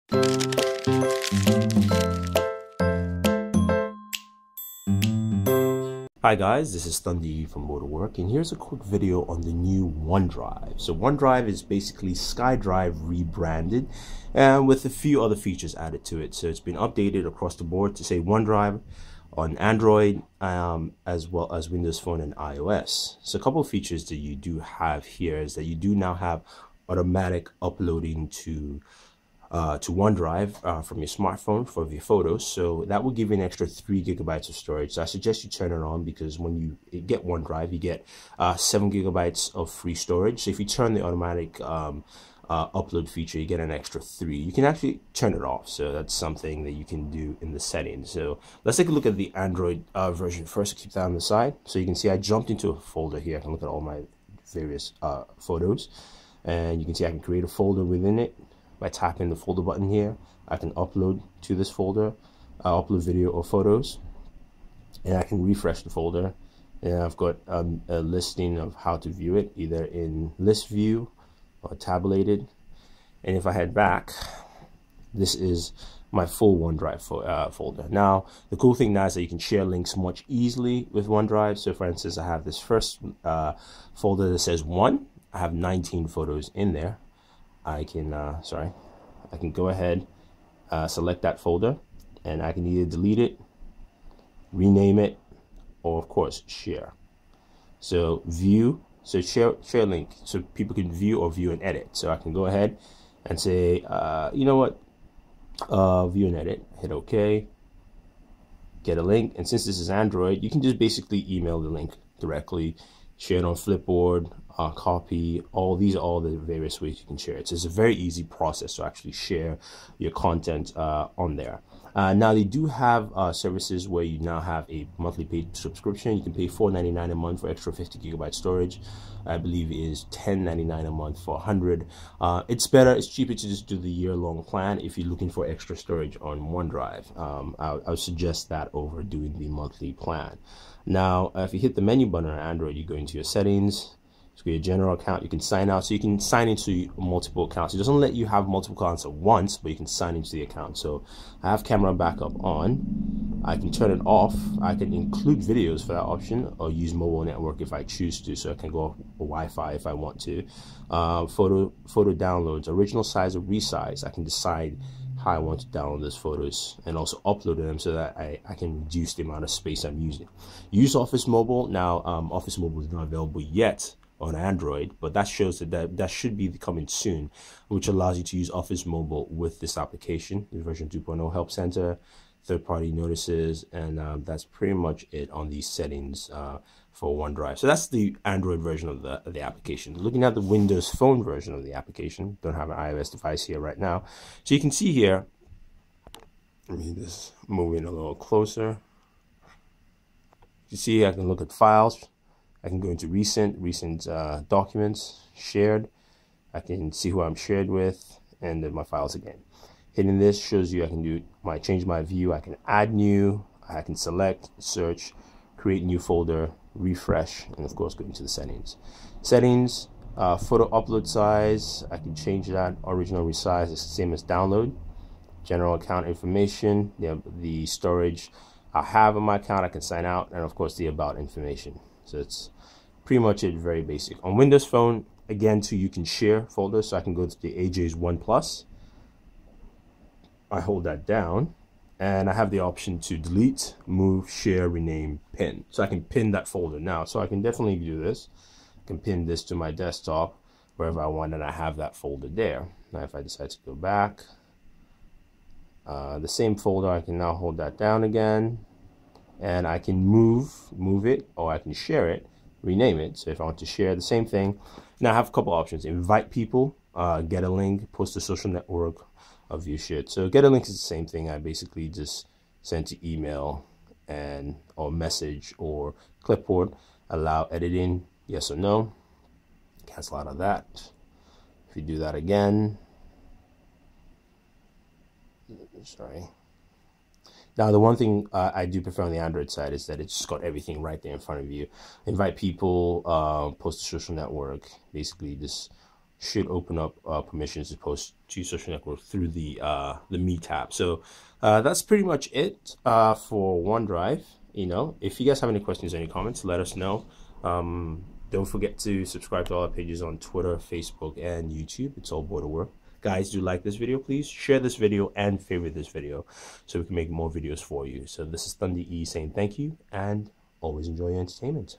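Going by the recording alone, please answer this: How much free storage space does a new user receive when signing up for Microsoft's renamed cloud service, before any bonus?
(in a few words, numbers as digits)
7 gigabytes.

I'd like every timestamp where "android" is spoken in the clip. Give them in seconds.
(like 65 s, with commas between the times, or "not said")
19 s, 49 s, 109 s, 142 s, 174 s, 188 s, 289 s.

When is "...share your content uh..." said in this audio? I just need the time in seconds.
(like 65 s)
119 s.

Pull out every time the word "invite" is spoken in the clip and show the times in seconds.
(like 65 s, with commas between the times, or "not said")
265 s, 292 s.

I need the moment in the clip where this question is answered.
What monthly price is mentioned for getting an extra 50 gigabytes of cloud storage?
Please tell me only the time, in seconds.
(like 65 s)
126 s.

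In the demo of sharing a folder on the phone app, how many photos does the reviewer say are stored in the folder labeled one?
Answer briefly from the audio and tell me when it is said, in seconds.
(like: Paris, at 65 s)
19, at 85 s.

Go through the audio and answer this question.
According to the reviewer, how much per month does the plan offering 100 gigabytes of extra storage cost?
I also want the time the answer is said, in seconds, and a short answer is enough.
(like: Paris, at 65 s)
$10.99, at 130 s.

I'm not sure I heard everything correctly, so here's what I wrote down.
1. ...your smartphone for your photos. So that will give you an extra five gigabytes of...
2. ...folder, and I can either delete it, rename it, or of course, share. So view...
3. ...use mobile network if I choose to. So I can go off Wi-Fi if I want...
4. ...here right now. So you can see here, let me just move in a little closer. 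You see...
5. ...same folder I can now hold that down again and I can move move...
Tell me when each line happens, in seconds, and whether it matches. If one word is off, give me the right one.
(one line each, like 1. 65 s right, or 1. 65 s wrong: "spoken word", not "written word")
1. 30 s wrong: "three", not "five"
2. 91 s right
3. 156 s right
4. 193 s right
5. 256 s right.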